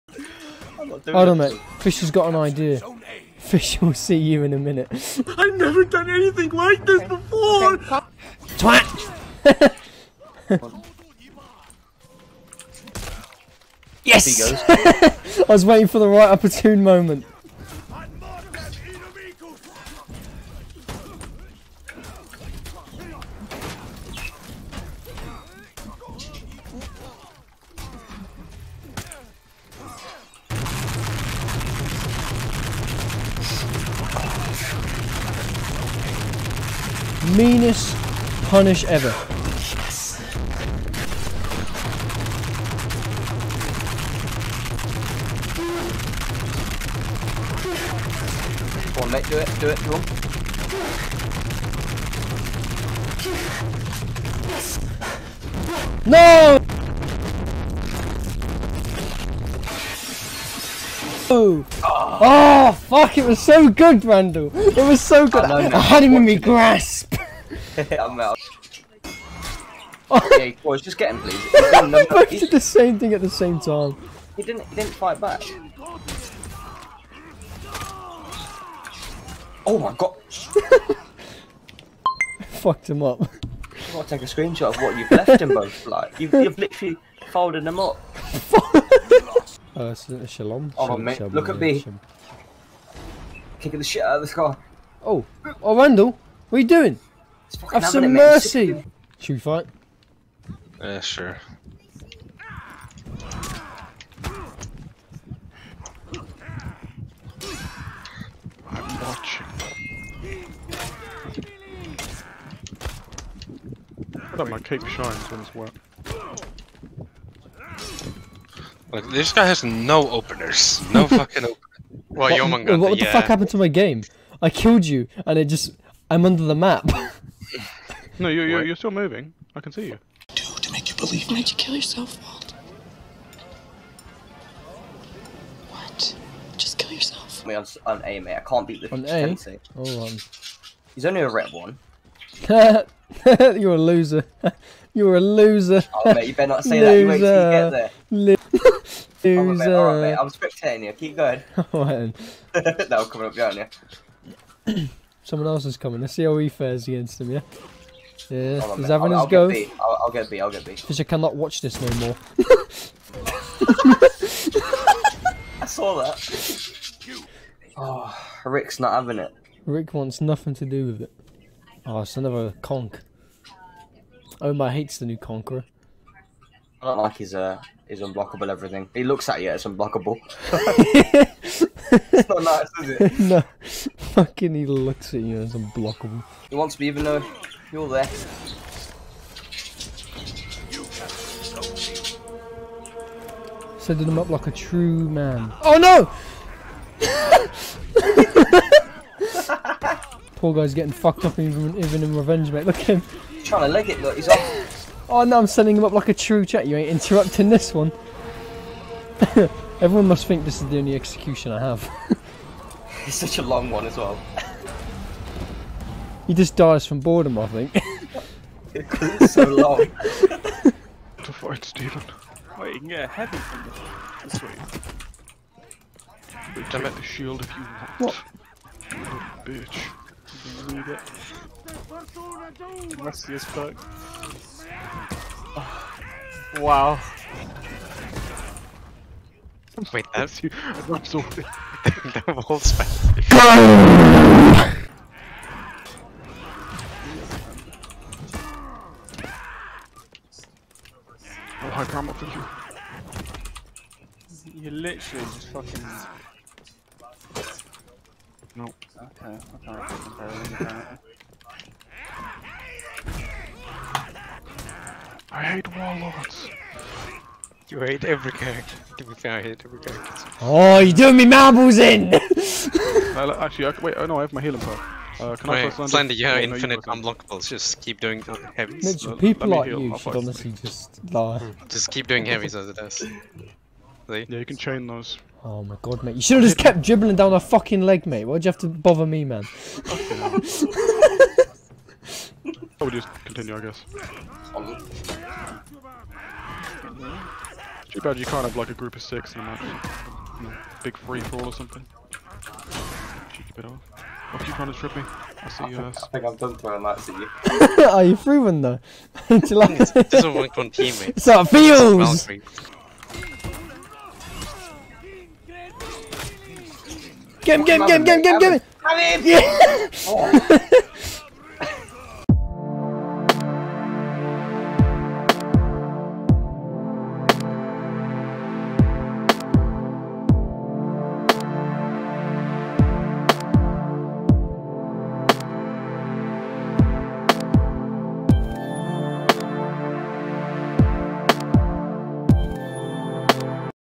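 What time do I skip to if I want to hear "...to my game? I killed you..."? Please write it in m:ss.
2:03.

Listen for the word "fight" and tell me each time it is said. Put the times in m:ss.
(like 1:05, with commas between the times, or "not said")
1:14, 1:39, 3:41.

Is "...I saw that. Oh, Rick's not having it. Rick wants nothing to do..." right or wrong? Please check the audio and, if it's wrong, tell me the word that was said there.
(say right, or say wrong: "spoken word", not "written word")
right.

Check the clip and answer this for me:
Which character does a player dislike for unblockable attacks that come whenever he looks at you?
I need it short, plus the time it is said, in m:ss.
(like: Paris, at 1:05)
Conqueror, at 2:55.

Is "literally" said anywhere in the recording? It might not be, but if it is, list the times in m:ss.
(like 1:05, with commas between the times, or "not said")
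1:26, 4:14.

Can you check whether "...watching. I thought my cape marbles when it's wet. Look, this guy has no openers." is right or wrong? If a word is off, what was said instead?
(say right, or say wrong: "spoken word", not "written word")
wrong: "shines", not "marbles".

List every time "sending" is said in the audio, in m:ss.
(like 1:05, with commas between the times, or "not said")
3:13, 3:25.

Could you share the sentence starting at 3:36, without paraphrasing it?
He just dies from boredom, I think.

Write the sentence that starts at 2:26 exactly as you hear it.
Oh, mate, you better not say that.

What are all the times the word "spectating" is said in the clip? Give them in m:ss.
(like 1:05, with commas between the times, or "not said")
2:30.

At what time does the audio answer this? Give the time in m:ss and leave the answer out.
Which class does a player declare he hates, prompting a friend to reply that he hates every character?
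4:25.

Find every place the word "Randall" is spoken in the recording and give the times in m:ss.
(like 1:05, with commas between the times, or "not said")
1:04, 1:35.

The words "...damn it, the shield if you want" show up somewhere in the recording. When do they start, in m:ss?
3:46.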